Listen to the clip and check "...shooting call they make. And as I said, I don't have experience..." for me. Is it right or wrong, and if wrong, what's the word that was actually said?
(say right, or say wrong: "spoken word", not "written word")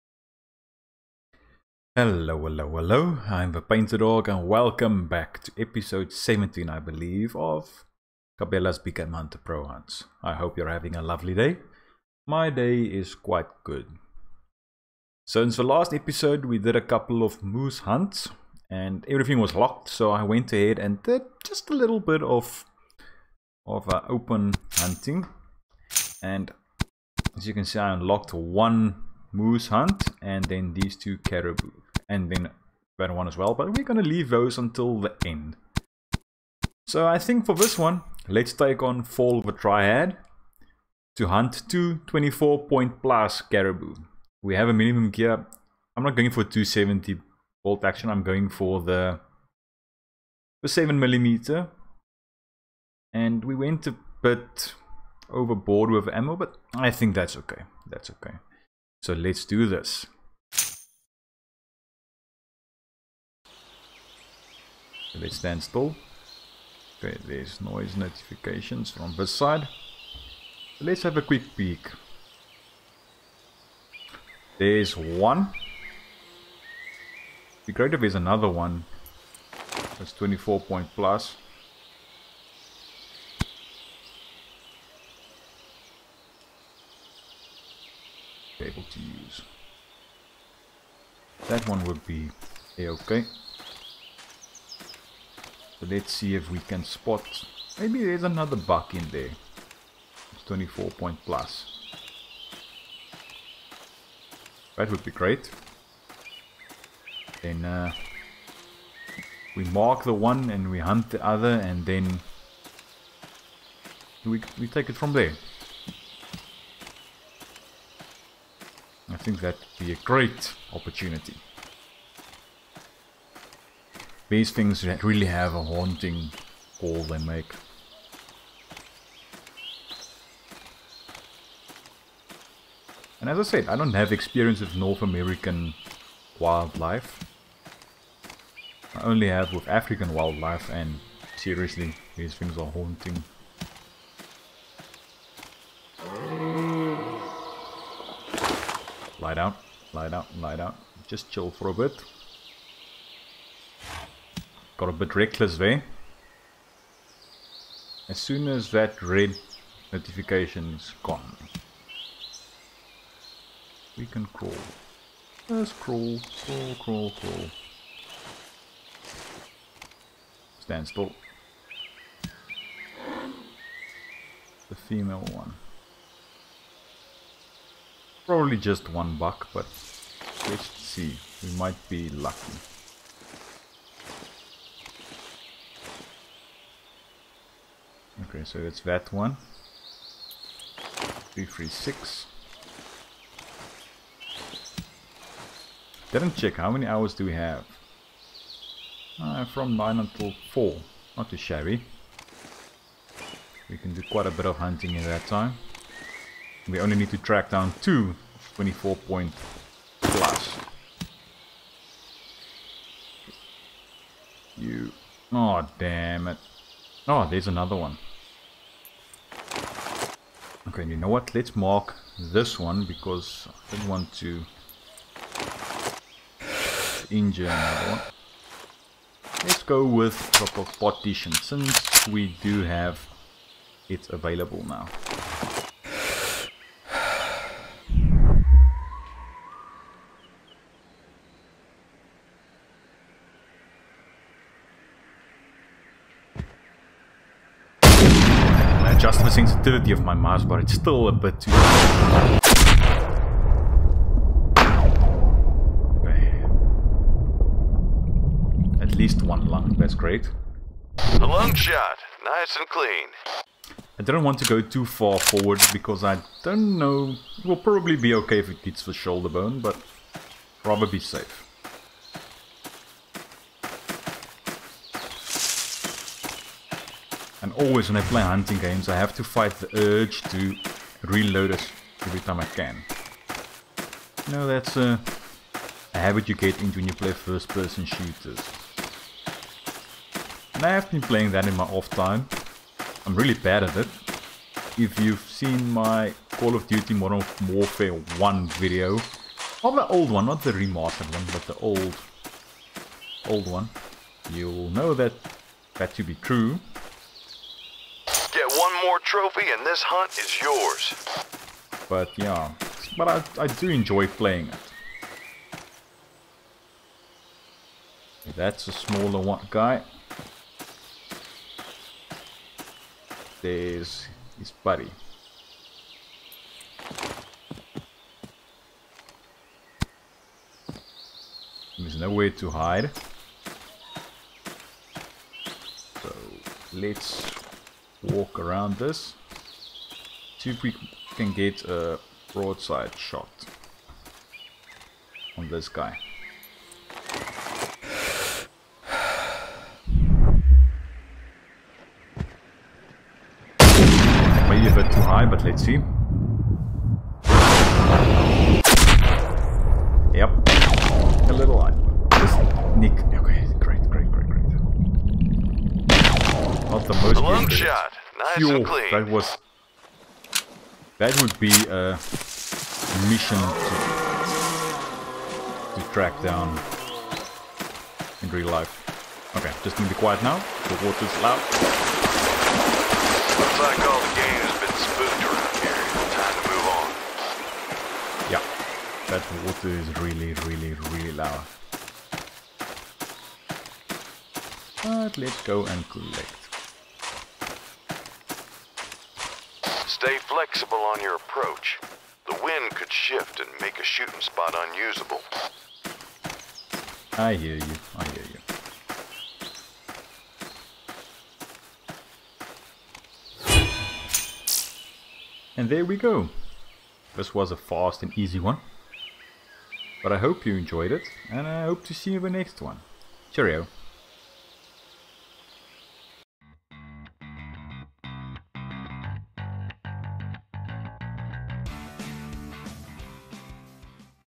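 wrong: "haunting", not "shooting".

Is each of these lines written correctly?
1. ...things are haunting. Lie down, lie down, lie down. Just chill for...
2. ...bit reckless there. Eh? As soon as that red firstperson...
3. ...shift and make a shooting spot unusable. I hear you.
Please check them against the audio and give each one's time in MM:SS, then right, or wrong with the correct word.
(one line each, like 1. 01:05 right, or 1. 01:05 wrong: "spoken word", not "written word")
1. 02:22 right
2. 02:34 wrong: "notification", not "firstperson"
3. 06:42 right.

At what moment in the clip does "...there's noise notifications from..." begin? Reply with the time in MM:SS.
01:07.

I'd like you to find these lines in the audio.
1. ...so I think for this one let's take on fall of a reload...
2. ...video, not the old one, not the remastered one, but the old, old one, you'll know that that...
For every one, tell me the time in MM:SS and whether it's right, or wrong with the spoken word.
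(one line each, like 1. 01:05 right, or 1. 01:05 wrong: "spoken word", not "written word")
1. 00:36 wrong: "triad", not "reload"
2. 04:58 right.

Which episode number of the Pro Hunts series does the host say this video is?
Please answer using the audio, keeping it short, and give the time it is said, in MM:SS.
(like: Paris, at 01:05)
17, at 00:05.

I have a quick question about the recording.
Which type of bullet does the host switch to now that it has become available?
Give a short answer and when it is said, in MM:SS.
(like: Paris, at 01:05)
partition, at 03:50.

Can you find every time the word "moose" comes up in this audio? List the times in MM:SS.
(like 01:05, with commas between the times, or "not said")
00:17, 00:29.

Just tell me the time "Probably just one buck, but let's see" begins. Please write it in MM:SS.
02:58.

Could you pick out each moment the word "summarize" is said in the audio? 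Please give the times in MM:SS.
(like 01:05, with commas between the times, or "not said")
not said.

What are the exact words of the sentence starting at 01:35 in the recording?
So let's see if we can spot...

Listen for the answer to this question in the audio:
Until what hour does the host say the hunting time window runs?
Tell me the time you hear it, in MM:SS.
03:20.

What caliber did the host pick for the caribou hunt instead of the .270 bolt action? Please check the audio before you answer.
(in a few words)
7 millimeter.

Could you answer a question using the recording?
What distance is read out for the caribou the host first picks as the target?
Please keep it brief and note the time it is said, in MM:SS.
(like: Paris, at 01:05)
336, at 03:11.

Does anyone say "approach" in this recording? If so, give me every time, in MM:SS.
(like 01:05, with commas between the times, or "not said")
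06:41.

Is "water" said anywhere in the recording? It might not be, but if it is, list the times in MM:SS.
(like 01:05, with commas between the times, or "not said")
06:20, 06:29.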